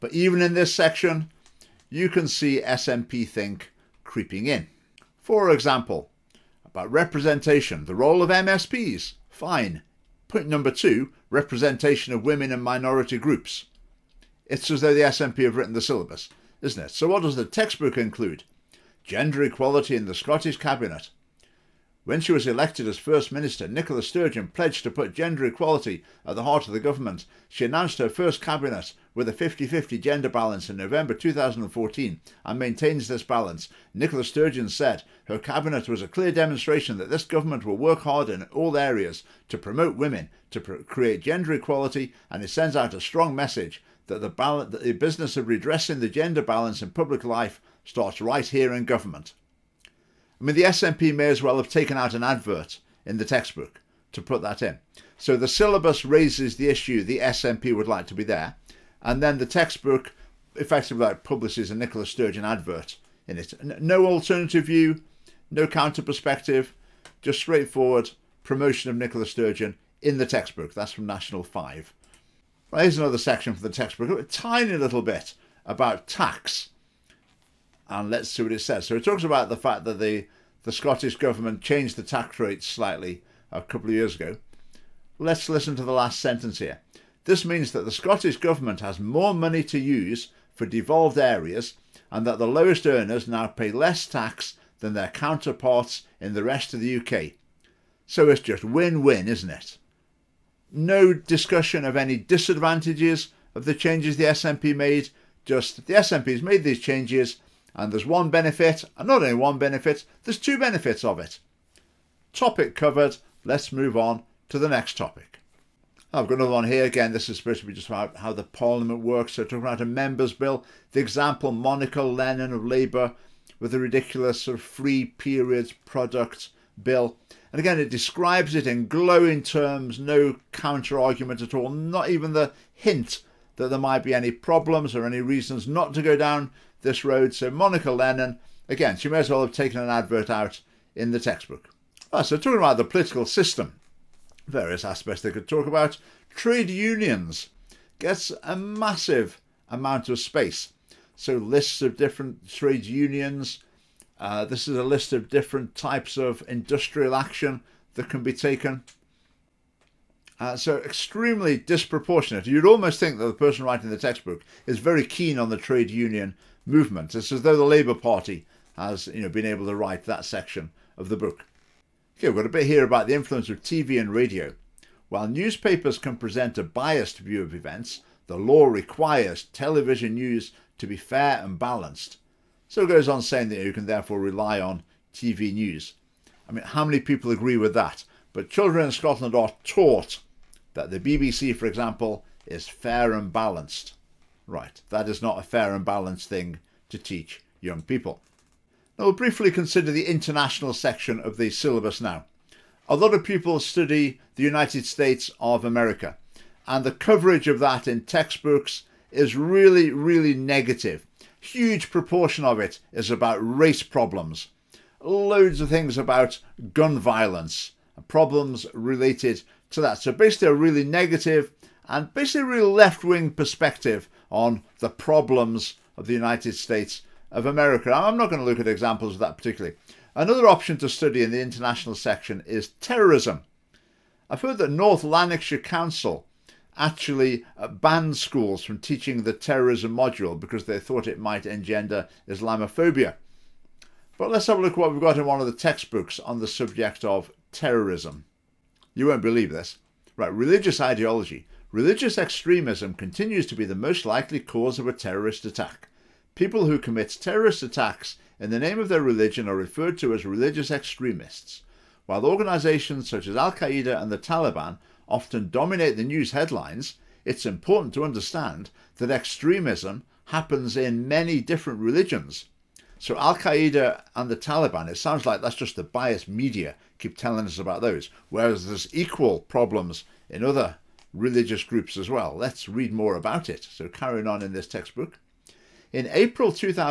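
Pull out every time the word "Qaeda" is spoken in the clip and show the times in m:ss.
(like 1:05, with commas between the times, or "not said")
4:23, 4:33.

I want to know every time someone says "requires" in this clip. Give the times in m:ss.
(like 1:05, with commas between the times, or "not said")
2:58.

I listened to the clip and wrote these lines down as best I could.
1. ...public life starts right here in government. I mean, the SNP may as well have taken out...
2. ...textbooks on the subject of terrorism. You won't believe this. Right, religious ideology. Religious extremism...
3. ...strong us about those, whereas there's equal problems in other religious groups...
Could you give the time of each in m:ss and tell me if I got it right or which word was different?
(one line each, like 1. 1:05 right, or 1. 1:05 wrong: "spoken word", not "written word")
1. 0:46 right
2. 4:05 right
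3. 4:37 wrong: "telling", not "strong".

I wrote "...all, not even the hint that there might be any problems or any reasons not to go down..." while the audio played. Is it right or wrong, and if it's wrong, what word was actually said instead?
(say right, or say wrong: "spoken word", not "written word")
right.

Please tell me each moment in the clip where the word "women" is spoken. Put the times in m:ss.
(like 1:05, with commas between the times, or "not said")
0:12, 0:39.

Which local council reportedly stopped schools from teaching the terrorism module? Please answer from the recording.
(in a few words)
North Lanarkshire Council.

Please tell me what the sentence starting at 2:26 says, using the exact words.
Trade unions gets a massive amount of space.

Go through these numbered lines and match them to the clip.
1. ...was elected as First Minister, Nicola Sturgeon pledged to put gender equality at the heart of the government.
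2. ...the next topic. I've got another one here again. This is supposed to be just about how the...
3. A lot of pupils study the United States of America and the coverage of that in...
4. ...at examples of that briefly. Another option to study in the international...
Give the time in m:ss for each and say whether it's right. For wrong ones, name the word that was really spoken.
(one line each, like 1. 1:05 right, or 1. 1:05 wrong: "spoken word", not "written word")
1. 0:22 right
2. 1:54 right
3. 3:22 right
4. 3:48 wrong: "particularly", not "briefly".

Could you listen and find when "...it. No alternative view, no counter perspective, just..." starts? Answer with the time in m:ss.
1:03.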